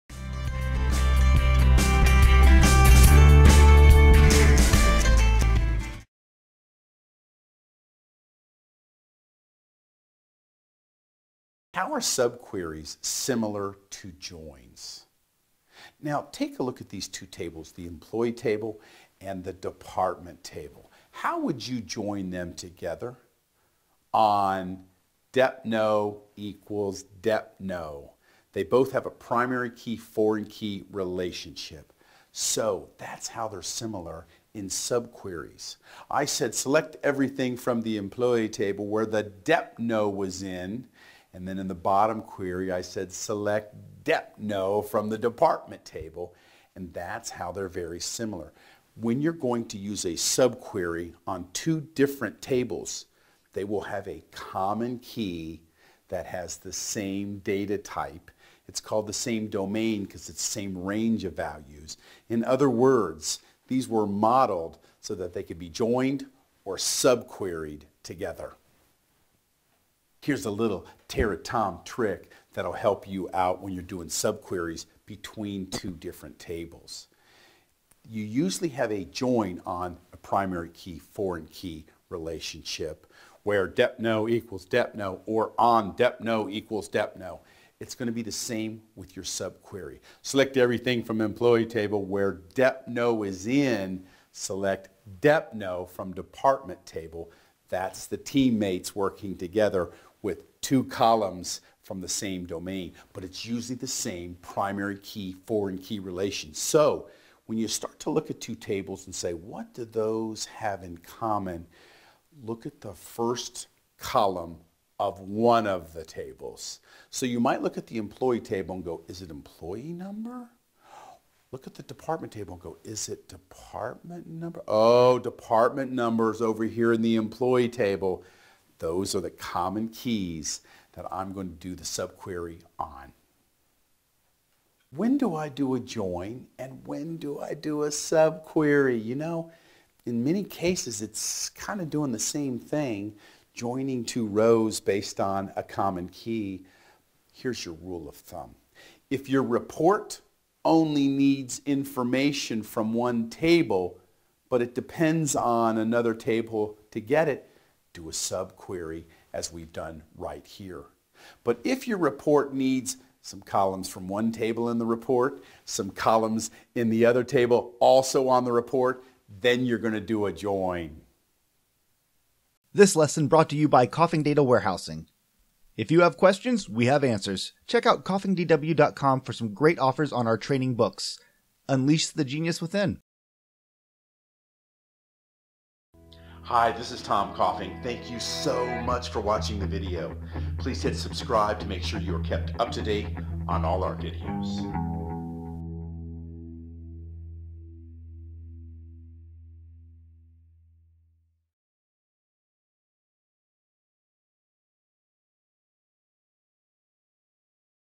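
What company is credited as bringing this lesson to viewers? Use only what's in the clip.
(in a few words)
Coffing Data Warehousing.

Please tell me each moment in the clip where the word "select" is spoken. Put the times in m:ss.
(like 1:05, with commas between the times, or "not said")
0:36, 0:43, 1:30, 1:34.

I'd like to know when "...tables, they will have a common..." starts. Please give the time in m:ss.
0:52.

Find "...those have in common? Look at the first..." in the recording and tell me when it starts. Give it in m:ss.
1:49.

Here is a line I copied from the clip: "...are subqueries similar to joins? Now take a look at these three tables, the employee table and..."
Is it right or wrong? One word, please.
wrong.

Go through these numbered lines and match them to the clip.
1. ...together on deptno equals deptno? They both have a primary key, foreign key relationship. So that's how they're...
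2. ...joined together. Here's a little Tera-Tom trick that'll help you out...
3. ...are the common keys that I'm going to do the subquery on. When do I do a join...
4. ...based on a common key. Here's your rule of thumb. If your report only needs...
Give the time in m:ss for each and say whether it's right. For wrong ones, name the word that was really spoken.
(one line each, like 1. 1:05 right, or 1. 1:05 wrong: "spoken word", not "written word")
1. 0:22 right
2. 1:06 wrong: "subqueried", not "joined"
3. 2:09 right
4. 2:24 right.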